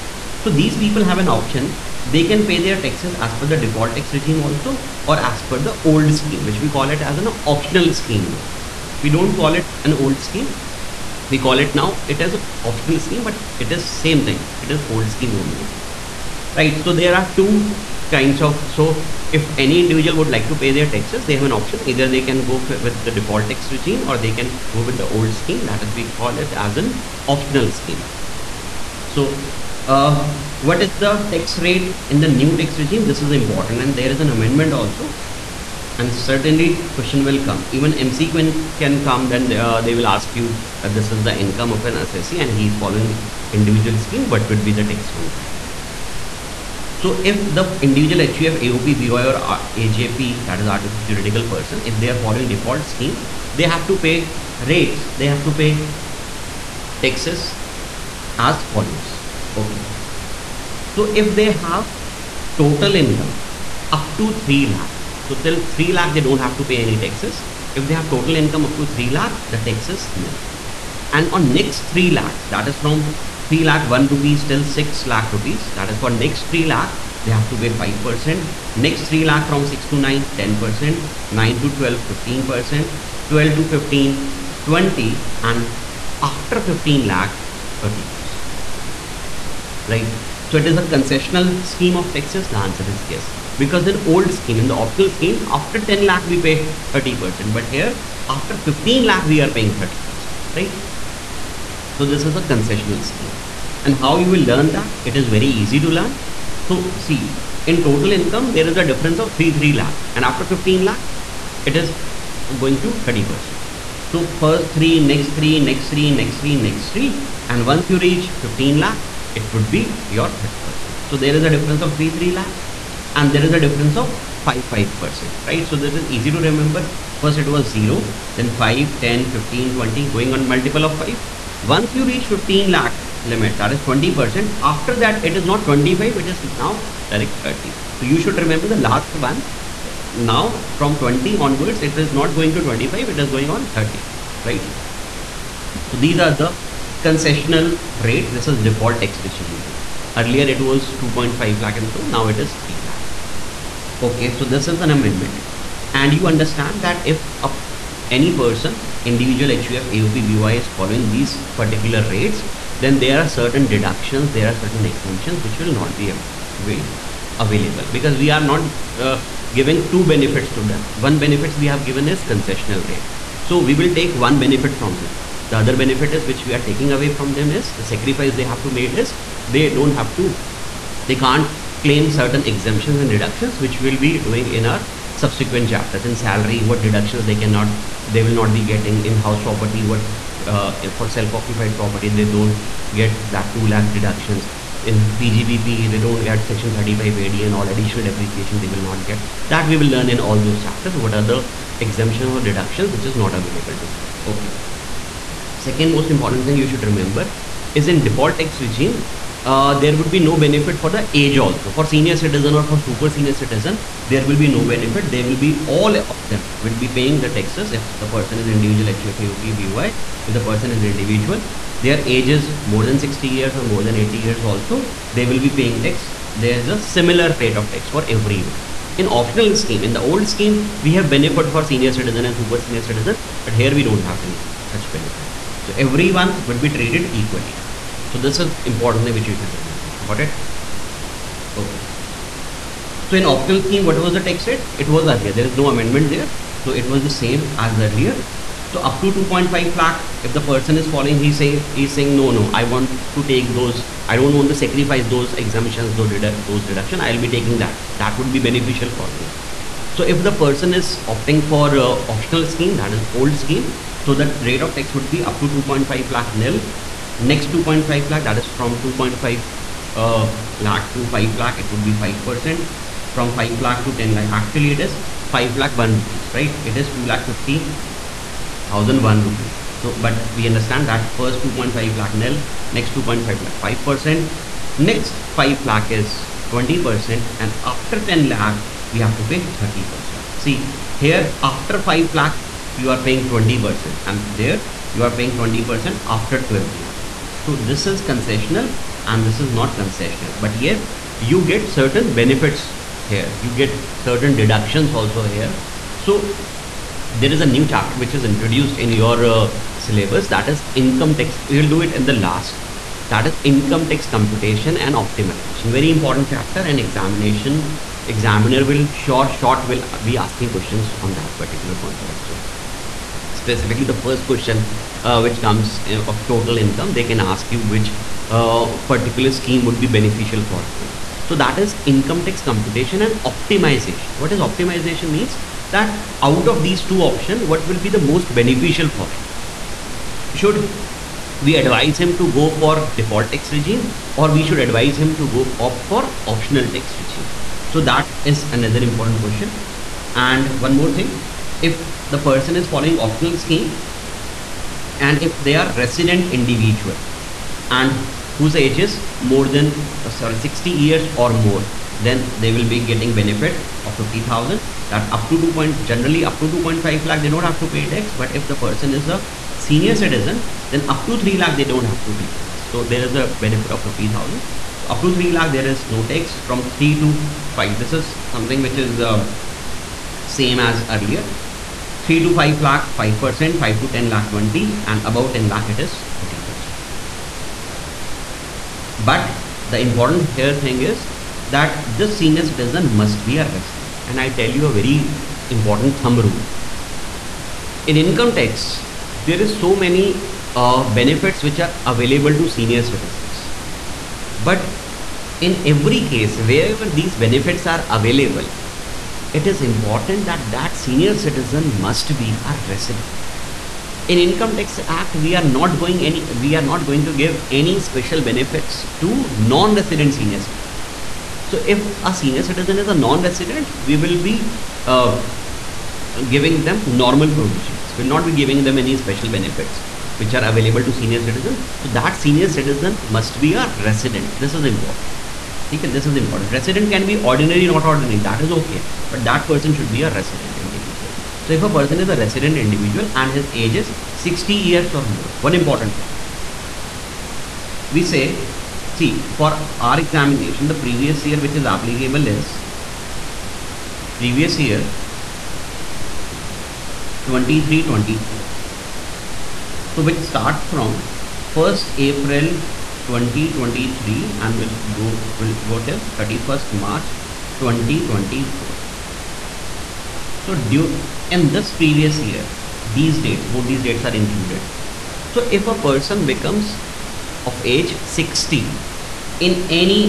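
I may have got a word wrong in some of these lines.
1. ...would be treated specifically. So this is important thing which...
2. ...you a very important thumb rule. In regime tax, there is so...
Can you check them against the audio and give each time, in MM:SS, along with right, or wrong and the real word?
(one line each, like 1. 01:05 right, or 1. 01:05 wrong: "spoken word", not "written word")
1. 03:56 wrong: "equally", not "specifically"
2. 06:34 wrong: "income", not "regime".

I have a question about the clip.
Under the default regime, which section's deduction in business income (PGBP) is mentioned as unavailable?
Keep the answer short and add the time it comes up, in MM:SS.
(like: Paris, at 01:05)
Section 35 AD, at 03:16.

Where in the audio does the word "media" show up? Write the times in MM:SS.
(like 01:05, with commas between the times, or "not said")
not said.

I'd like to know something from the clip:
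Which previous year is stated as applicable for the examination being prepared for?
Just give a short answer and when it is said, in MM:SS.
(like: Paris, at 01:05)
2023-24, at 07:34.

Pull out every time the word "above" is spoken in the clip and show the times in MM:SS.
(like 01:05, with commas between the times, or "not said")
06:25.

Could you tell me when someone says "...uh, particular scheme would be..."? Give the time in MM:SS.
05:28.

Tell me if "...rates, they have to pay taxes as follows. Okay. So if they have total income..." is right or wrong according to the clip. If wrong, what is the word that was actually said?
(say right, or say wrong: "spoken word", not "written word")
right.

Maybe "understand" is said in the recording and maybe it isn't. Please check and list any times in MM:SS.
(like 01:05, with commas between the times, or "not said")
02:36, 04:40.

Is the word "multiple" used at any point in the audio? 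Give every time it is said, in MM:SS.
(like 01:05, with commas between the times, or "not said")
02:10.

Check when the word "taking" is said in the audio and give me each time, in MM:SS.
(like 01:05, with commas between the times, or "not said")
02:56, 04:17.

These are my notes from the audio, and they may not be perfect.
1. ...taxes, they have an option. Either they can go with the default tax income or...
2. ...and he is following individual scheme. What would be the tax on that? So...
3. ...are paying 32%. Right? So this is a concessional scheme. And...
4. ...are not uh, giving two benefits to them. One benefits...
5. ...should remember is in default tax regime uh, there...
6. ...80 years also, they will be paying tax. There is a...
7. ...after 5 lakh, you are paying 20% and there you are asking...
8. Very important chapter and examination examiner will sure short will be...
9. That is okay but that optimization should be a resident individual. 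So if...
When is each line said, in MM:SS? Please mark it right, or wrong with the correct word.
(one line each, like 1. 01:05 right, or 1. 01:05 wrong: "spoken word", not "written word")
1. 00:20 wrong: "regime", not "income"
2. 00:42 right
3. 01:39 wrong: "30", not "32"
4. 02:48 right
5. 03:26 right
6. 03:43 right
7. 04:51 wrong: "paying", not "asking"
8. 05:15 right
9. 07:18 wrong: "person", not "optimization".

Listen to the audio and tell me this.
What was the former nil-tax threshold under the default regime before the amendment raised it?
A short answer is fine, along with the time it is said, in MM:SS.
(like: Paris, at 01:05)
2.5 lakh, at 02:30.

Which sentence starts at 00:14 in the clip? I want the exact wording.
It is old scheme only right?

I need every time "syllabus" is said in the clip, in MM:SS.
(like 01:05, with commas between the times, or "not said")
05:09.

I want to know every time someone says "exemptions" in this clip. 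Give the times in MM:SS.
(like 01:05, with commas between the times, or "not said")
02:44, 03:02, 03:21.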